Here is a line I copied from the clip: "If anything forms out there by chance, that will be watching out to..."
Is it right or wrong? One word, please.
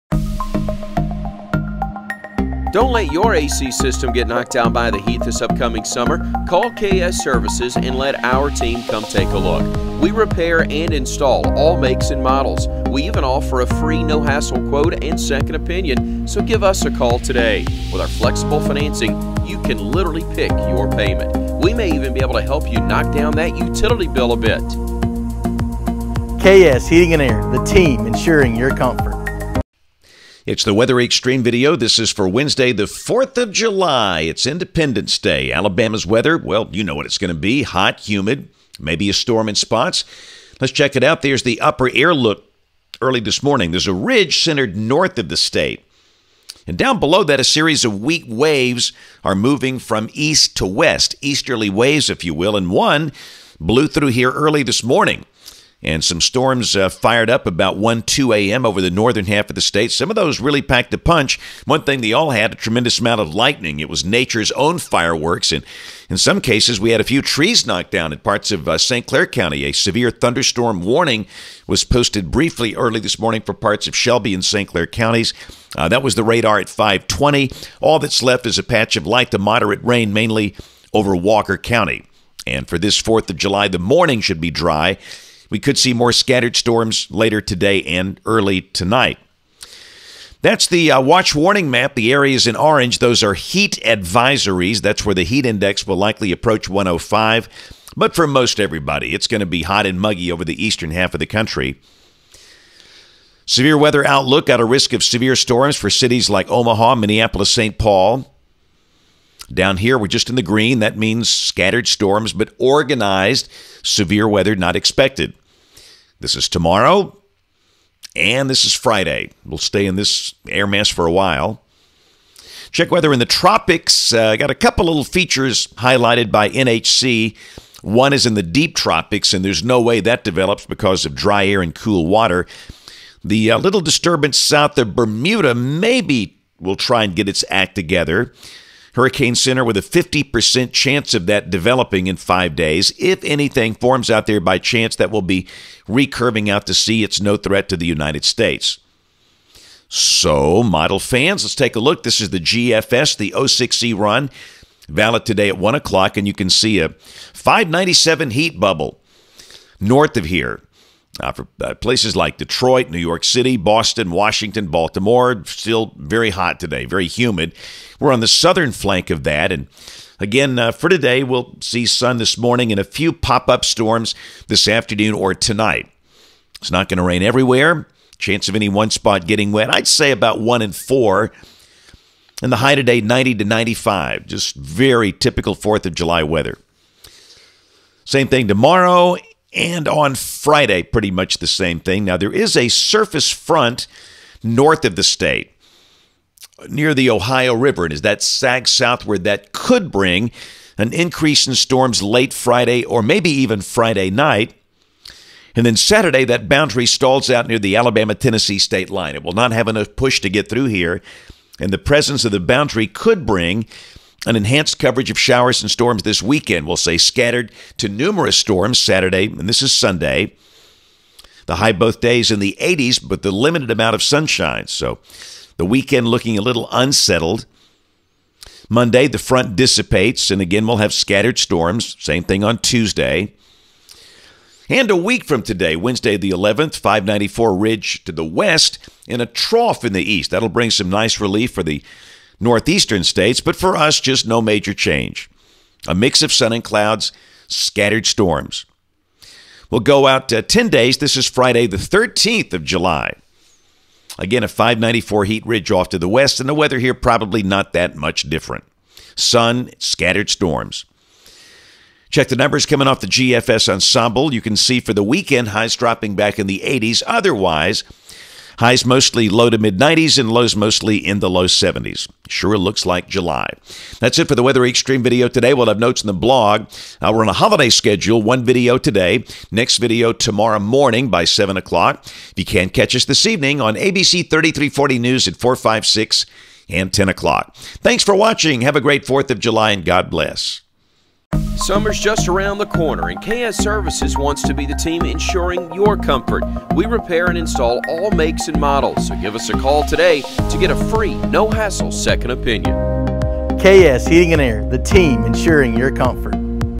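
wrong.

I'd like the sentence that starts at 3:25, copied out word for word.
And then Saturday, that boundary stalls out near the Alabama Tennessee state line.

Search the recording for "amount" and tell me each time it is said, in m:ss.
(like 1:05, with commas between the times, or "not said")
1:02, 3:43.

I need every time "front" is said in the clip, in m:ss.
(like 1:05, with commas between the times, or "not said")
3:13, 3:49.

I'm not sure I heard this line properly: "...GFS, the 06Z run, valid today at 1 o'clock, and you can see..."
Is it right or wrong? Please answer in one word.
right.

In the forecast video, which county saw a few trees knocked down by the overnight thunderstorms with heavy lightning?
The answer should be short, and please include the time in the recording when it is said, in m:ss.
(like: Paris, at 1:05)
St. Clair County, at 1:08.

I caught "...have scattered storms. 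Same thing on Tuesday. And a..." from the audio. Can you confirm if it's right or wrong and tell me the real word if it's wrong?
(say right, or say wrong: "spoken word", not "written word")
right.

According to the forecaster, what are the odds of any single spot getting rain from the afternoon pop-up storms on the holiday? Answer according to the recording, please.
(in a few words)
1 in 4.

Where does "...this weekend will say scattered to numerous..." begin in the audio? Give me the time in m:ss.
3:36.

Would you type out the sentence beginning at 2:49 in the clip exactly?
And again, uh, for today, we'll see sun this morning and a few pop up storms this afternoon or tonight.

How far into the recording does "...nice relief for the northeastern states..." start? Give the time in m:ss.
4:00.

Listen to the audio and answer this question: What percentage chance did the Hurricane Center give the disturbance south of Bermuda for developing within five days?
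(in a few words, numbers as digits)
50%.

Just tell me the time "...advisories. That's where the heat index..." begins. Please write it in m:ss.
1:33.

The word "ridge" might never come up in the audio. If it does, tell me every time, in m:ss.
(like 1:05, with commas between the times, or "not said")
0:43, 3:57, 4:15.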